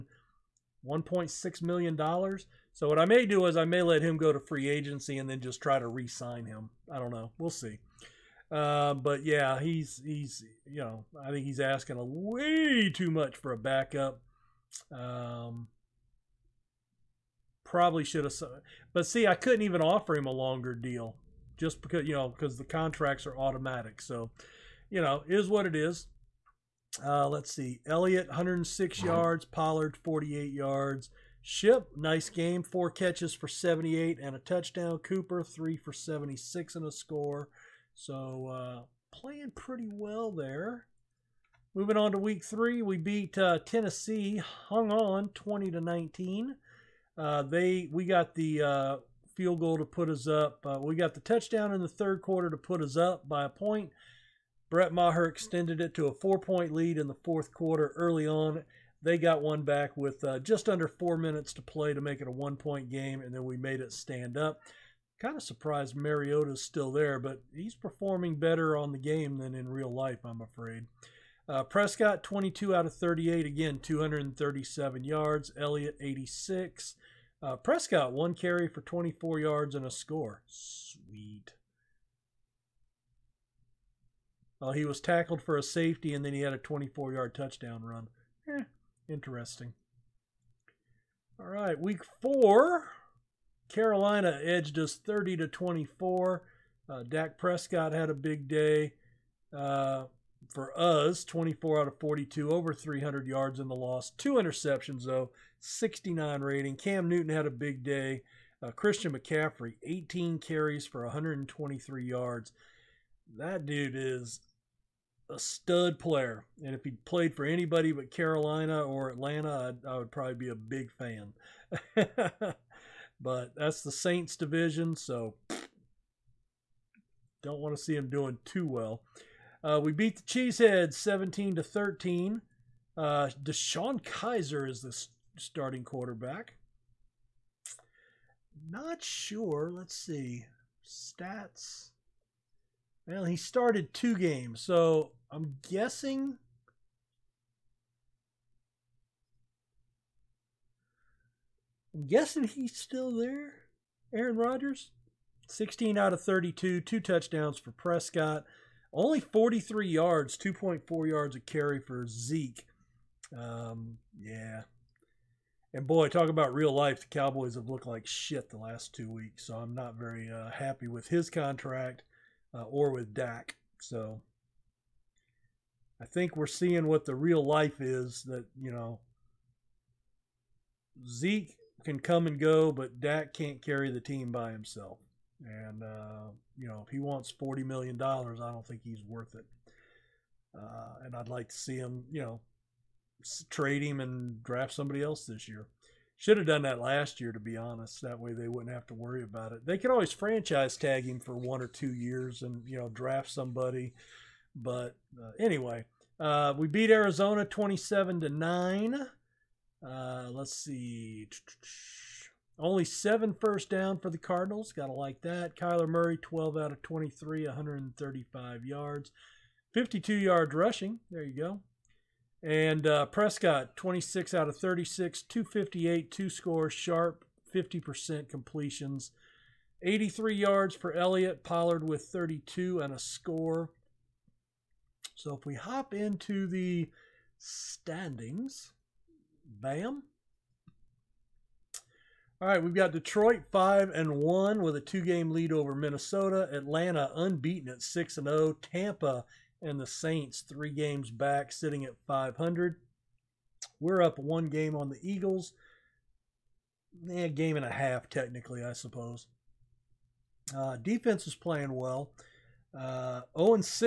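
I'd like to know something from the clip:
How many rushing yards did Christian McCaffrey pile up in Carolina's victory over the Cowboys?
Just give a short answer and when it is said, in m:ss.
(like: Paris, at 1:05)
123 yards, at 1:51.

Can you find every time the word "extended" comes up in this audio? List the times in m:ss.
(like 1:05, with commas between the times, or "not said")
0:55.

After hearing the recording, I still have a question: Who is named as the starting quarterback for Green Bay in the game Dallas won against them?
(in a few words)
DeShone Kizer.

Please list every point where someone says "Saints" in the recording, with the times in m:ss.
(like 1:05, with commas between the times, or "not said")
2:03, 4:09.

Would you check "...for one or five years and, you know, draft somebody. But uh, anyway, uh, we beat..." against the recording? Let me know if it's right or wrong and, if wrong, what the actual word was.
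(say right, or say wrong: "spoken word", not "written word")
wrong: "two", not "five".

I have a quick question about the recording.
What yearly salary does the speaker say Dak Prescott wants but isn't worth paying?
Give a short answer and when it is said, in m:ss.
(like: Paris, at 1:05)
$40 million, at 3:07.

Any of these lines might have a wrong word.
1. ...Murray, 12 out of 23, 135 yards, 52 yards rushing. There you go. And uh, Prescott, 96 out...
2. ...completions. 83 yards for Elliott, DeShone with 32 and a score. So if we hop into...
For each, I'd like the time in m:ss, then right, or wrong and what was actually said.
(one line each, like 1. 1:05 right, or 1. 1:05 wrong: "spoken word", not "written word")
1. 3:35 wrong: "26", not "96"
2. 3:48 wrong: "Pollard", not "DeShone".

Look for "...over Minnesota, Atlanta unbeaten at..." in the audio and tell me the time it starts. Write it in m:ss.
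4:05.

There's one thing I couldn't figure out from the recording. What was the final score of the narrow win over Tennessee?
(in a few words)
20-19.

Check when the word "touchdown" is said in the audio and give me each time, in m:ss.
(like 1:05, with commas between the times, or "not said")
0:34, 0:51, 1:27, 2:36.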